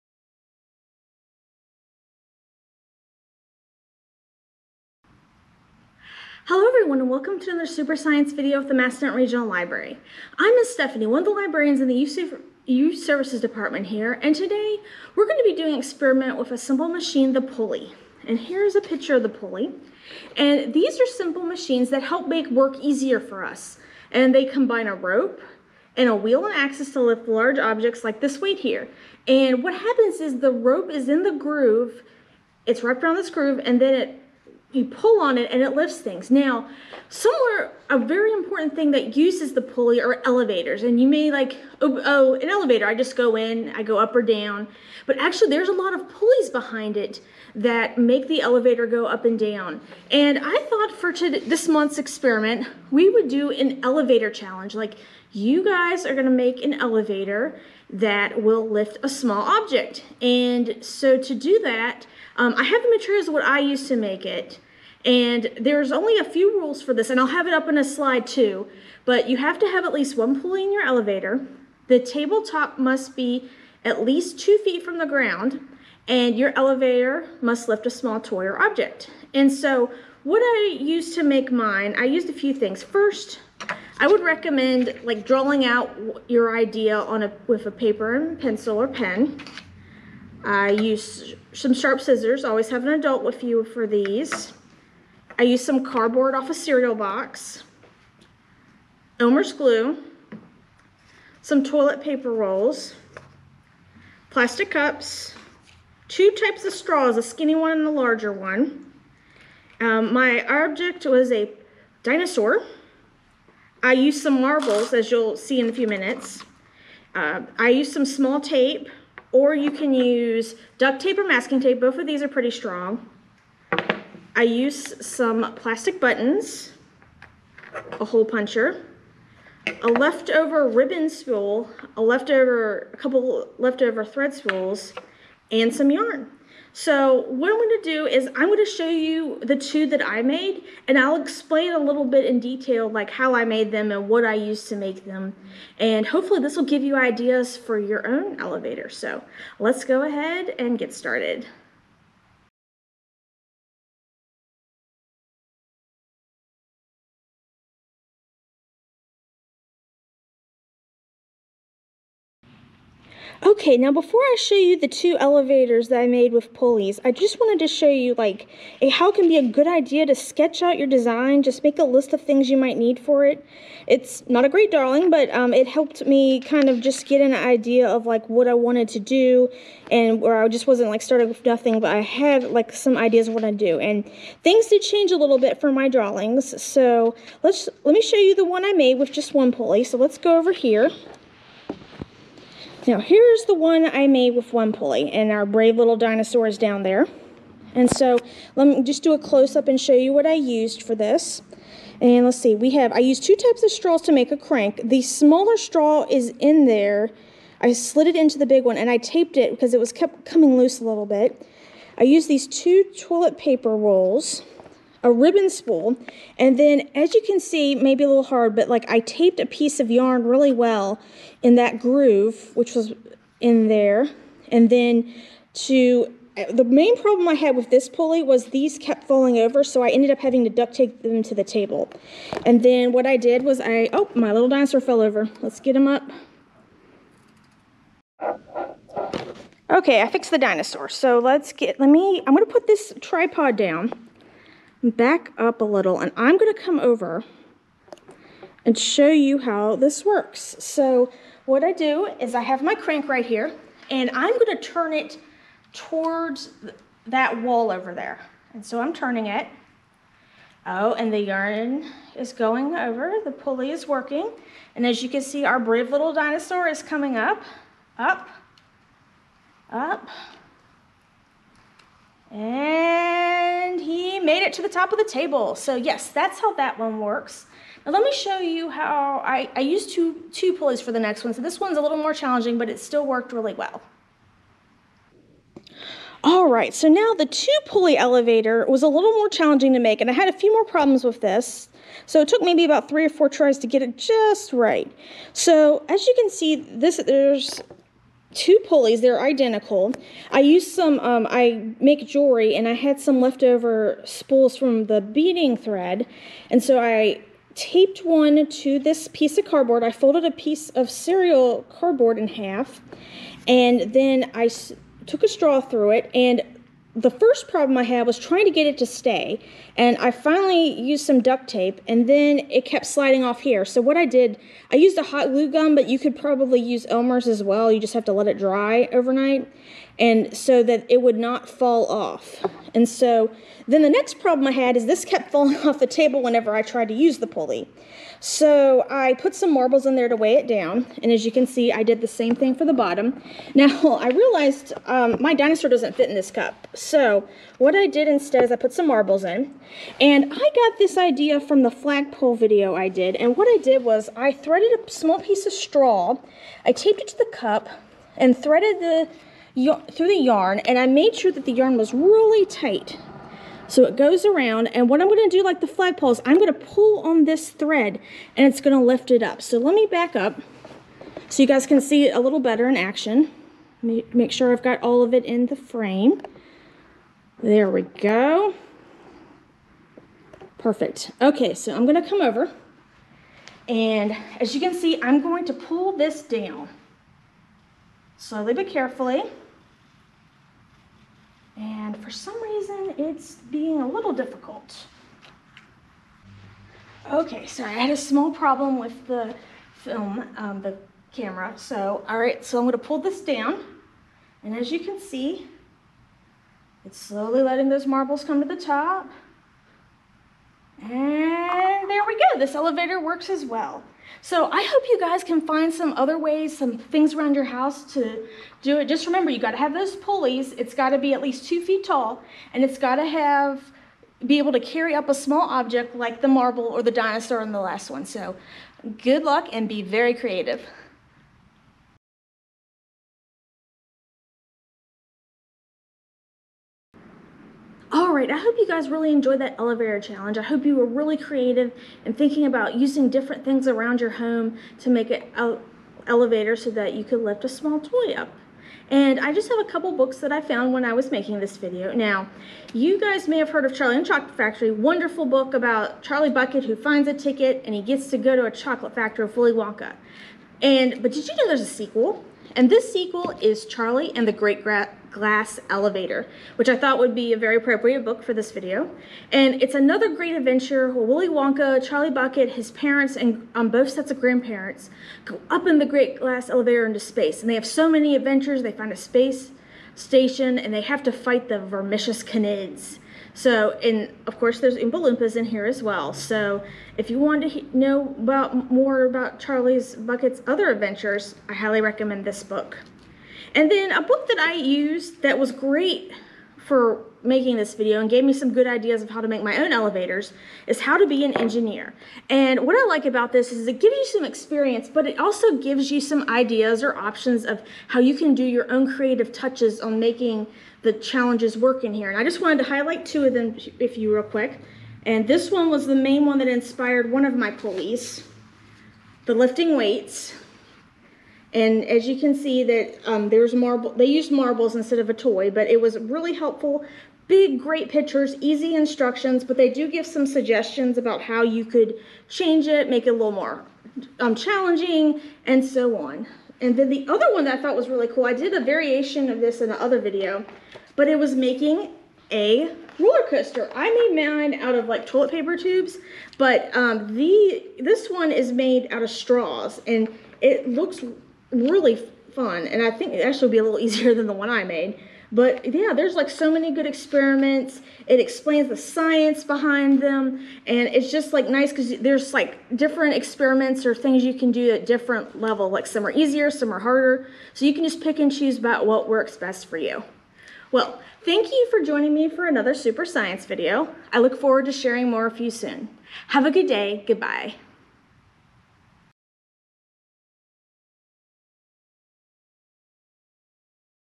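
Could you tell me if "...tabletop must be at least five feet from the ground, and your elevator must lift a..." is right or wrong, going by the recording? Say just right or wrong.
wrong.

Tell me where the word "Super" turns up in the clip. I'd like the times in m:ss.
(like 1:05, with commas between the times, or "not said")
0:07, 9:32.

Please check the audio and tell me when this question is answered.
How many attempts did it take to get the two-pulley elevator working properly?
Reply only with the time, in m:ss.
4:52.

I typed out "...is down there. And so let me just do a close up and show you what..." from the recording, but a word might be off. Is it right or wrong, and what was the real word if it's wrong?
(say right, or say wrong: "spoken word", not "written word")
right.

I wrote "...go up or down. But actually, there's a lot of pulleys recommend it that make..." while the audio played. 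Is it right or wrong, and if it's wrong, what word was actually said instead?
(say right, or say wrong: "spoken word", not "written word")
wrong: "behind", not "recommend".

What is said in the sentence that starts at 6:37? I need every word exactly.
Okay, so I had a small problem with the film, um, the camera.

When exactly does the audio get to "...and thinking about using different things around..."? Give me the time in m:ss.
7:22.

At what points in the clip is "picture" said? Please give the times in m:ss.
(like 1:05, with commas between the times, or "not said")
0:18, 8:47.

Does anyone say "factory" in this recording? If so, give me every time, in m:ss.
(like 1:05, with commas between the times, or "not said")
7:34, 7:38.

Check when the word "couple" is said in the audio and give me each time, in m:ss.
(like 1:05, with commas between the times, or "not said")
2:12, 7:29.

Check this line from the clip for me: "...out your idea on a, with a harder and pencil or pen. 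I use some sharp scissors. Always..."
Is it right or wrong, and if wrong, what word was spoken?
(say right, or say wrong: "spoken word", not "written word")
wrong: "paper", not "harder".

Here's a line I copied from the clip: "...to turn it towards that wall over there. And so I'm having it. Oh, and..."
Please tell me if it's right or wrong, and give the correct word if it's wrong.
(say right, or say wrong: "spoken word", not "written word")
wrong: "turning", not "having".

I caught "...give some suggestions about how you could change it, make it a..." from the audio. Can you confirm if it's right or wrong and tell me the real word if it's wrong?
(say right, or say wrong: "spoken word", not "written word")
right.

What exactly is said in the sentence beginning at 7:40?
And, but did you know there's a sequel?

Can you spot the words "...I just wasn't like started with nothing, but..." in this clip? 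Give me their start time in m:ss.
3:00.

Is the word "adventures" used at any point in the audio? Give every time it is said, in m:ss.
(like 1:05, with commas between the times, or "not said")
7:50, 7:58, 8:10.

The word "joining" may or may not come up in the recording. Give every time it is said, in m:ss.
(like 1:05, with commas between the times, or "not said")
9:31.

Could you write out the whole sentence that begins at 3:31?
I used these two toilet paper rolls a ribbon spool.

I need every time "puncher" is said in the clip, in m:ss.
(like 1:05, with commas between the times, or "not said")
2:08.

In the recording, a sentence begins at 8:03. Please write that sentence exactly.
So, and of course, there's Oompa Loompas in here as well.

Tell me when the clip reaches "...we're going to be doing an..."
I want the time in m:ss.
0:15.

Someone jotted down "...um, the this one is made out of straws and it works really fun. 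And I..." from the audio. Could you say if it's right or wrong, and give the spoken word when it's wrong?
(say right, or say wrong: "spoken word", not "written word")
wrong: "looks", not "works".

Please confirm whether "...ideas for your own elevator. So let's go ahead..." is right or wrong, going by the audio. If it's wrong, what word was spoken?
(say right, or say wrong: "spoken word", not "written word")
right.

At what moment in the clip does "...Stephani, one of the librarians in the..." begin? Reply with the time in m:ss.
0:10.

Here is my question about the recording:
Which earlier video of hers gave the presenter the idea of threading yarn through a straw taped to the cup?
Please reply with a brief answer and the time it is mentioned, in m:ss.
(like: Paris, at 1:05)
The flagpole video, at 5:51.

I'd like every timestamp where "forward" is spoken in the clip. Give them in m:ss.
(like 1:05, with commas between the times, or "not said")
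9:34.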